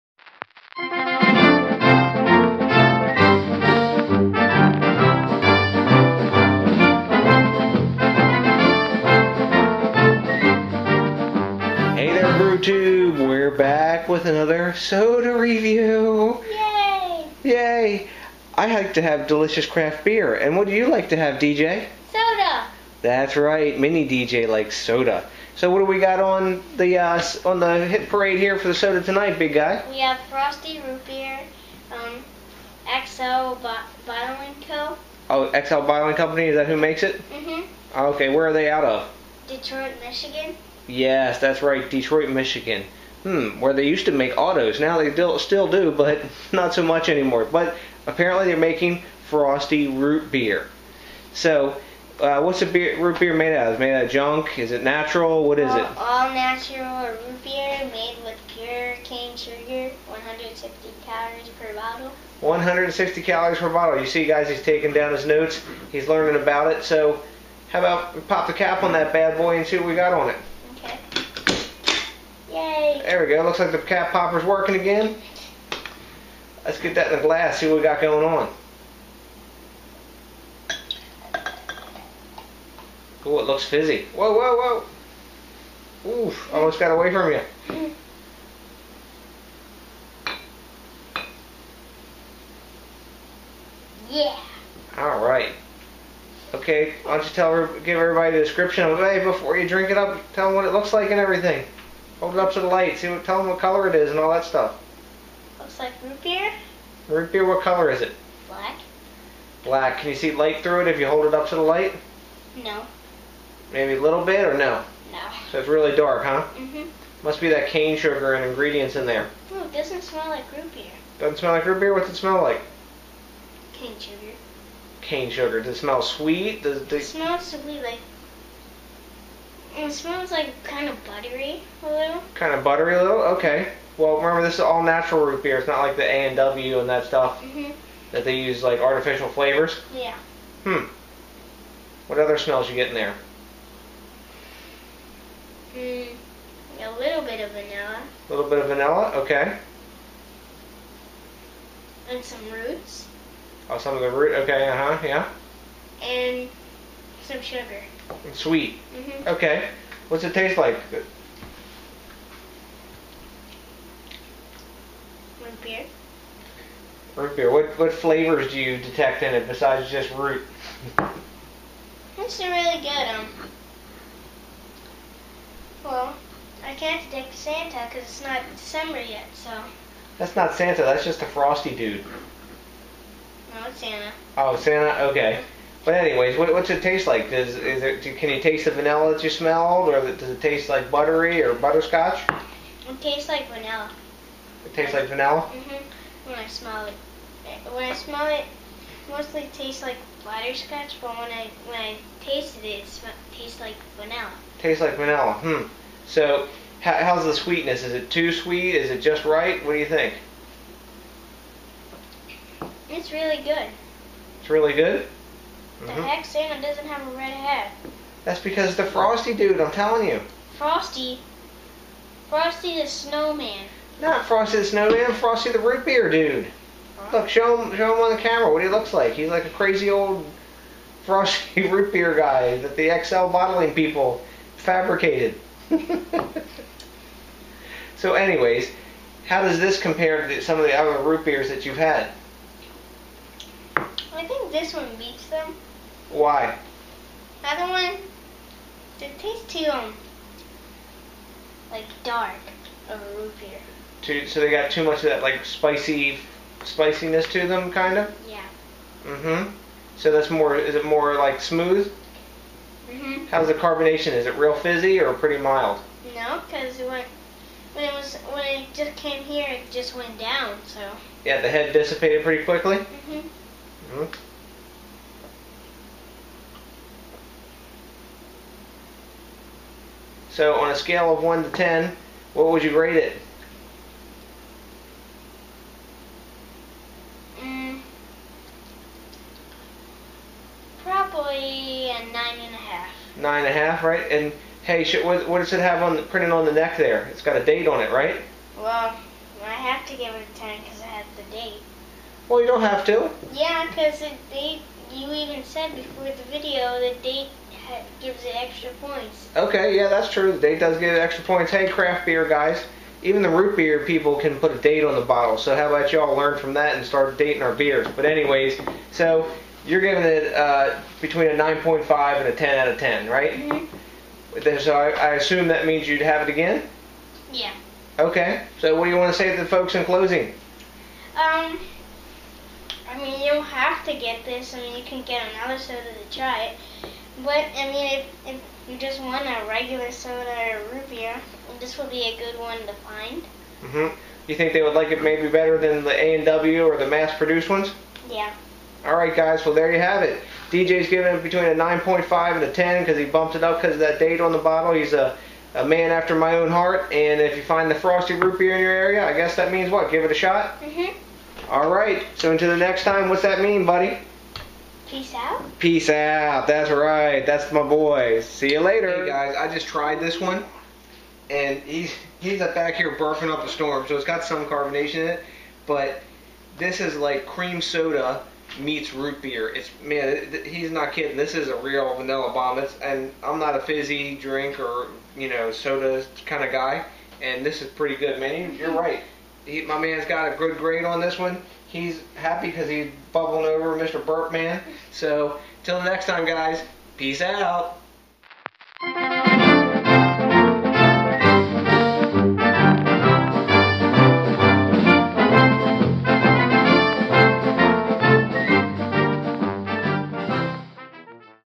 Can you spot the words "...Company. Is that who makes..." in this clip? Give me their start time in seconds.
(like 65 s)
36 s.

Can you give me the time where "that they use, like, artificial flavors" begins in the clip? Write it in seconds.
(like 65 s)
138 s.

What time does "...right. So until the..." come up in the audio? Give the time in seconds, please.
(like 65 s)
361 s.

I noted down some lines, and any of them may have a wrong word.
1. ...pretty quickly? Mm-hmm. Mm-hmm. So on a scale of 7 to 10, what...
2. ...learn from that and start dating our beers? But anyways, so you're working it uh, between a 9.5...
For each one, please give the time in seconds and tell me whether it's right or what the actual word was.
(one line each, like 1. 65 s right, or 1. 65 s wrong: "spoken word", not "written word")
1. 272 s wrong: "1", not "7"
2. 316 s wrong: "giving", not "working".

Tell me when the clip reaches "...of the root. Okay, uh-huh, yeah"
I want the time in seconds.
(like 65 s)
153 s.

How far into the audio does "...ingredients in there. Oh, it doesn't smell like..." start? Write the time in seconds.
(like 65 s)
118 s.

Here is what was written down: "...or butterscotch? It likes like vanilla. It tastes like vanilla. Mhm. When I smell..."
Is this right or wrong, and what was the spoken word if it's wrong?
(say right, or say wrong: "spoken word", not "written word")
wrong: "tastes", not "likes".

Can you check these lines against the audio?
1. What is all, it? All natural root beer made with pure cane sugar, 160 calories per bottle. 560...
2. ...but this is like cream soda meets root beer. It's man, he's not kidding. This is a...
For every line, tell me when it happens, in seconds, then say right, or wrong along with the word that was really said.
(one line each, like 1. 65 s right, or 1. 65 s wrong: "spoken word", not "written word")
1. 55 s wrong: "160", not "560"
2. 375 s right.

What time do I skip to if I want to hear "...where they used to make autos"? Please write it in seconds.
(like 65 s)
43 s.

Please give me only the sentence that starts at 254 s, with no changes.
Too, so they got too much of that, like, spicy spiciness to them, kind of?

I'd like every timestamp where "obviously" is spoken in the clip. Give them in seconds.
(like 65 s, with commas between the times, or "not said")
not said.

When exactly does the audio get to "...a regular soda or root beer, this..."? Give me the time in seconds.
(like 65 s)
339 s.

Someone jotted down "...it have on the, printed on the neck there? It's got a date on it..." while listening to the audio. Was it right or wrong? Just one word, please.
right.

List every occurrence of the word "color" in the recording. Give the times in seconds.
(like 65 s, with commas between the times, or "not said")
103 s, 107 s.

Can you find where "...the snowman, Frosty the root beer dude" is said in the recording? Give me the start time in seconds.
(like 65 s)
224 s.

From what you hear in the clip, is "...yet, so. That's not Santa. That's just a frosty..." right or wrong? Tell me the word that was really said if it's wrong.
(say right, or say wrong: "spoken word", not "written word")
right.